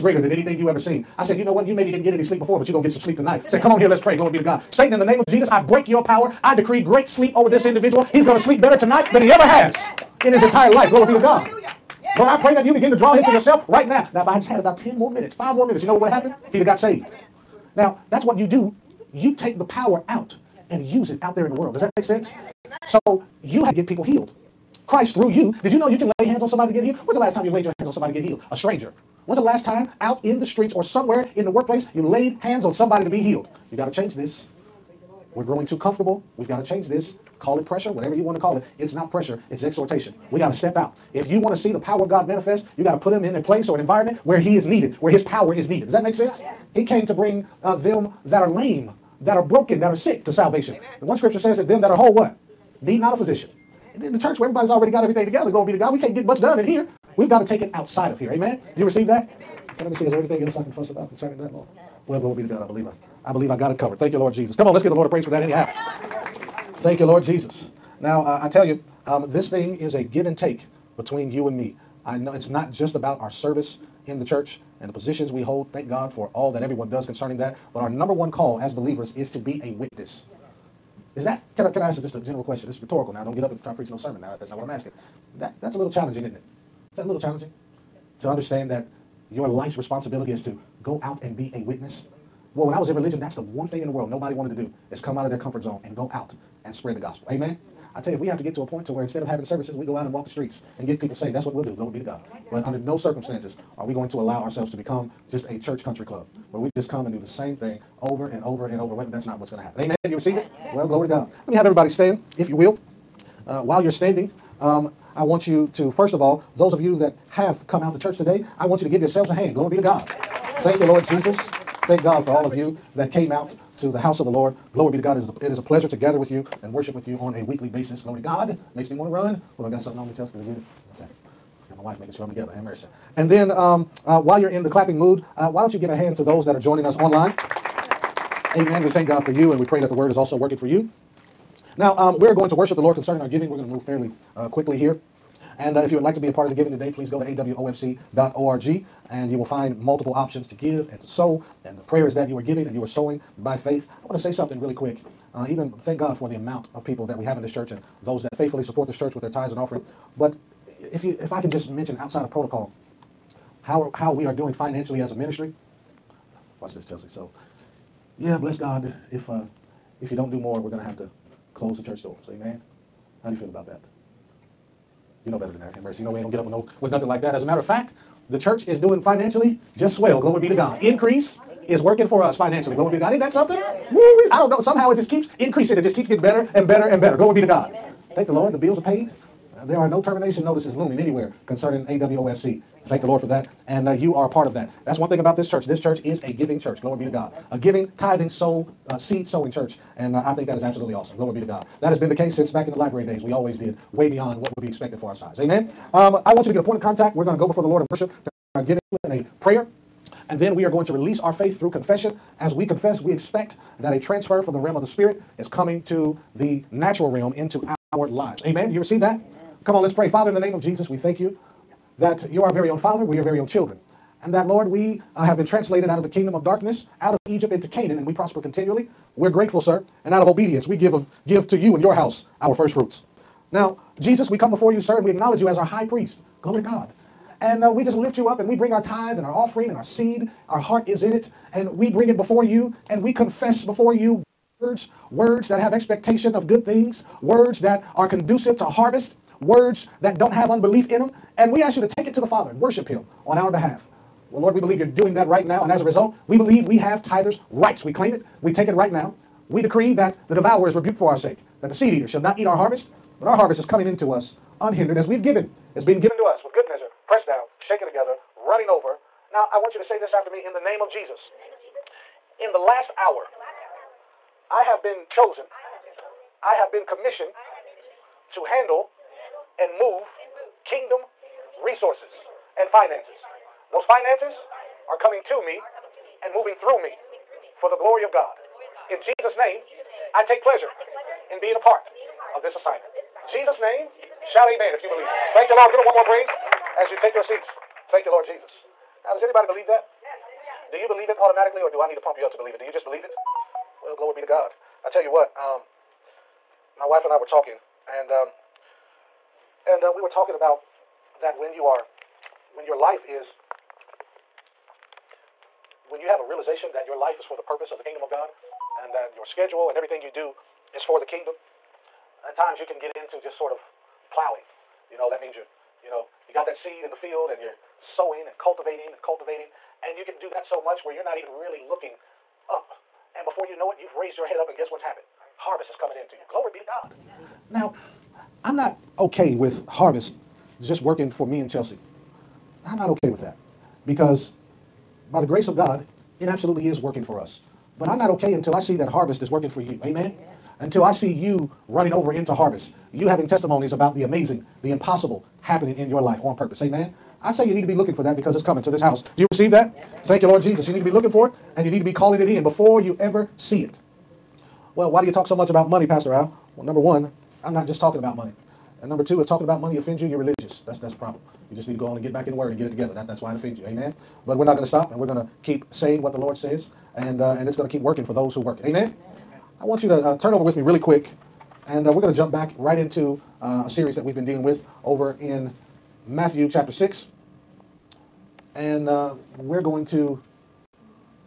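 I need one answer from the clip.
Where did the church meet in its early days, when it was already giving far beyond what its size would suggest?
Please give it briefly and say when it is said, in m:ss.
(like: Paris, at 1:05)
The library, at 3:22.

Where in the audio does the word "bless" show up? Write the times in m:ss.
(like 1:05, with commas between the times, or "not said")
2:48.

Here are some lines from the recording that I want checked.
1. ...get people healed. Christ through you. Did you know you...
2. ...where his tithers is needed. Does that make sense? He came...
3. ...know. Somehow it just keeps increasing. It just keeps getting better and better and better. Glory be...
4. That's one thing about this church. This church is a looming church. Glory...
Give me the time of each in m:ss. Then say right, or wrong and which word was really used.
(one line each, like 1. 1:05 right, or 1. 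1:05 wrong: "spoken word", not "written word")
1. 0:23 right
2. 0:45 wrong: "power", not "tithers"
3. 3:04 right
4. 3:14 wrong: "giving", not "looming".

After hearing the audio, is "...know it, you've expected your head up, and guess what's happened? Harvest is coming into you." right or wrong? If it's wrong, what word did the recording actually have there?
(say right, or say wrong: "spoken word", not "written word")
wrong: "raised", not "expected".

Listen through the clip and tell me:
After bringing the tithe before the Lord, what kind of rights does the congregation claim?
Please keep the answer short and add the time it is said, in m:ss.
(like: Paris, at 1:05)
Tithers' rights, at 4:17.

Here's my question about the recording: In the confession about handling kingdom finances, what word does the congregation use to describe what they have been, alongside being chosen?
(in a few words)
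Commissioned.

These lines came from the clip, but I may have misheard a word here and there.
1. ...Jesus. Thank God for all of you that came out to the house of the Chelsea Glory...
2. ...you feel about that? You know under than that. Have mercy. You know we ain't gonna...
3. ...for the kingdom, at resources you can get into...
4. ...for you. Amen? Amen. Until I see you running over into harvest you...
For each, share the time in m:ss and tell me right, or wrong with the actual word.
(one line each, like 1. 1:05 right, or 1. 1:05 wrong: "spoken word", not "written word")
1. 2:01 wrong: "Lord", not "Chelsea"
2. 2:53 wrong: "better", not "under"
3. 5:20 wrong: "times", not "resources"
4. 5:49 right.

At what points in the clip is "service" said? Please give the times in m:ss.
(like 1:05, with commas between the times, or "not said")
1:13, 1:39.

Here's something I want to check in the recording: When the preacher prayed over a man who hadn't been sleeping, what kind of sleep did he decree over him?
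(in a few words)
Great sleep.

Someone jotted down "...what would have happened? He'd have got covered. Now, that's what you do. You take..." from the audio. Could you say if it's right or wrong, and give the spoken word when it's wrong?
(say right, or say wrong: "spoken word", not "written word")
wrong: "saved", not "covered".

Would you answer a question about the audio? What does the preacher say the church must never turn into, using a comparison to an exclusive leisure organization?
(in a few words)
Church country club.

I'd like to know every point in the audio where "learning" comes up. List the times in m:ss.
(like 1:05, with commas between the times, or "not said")
not said.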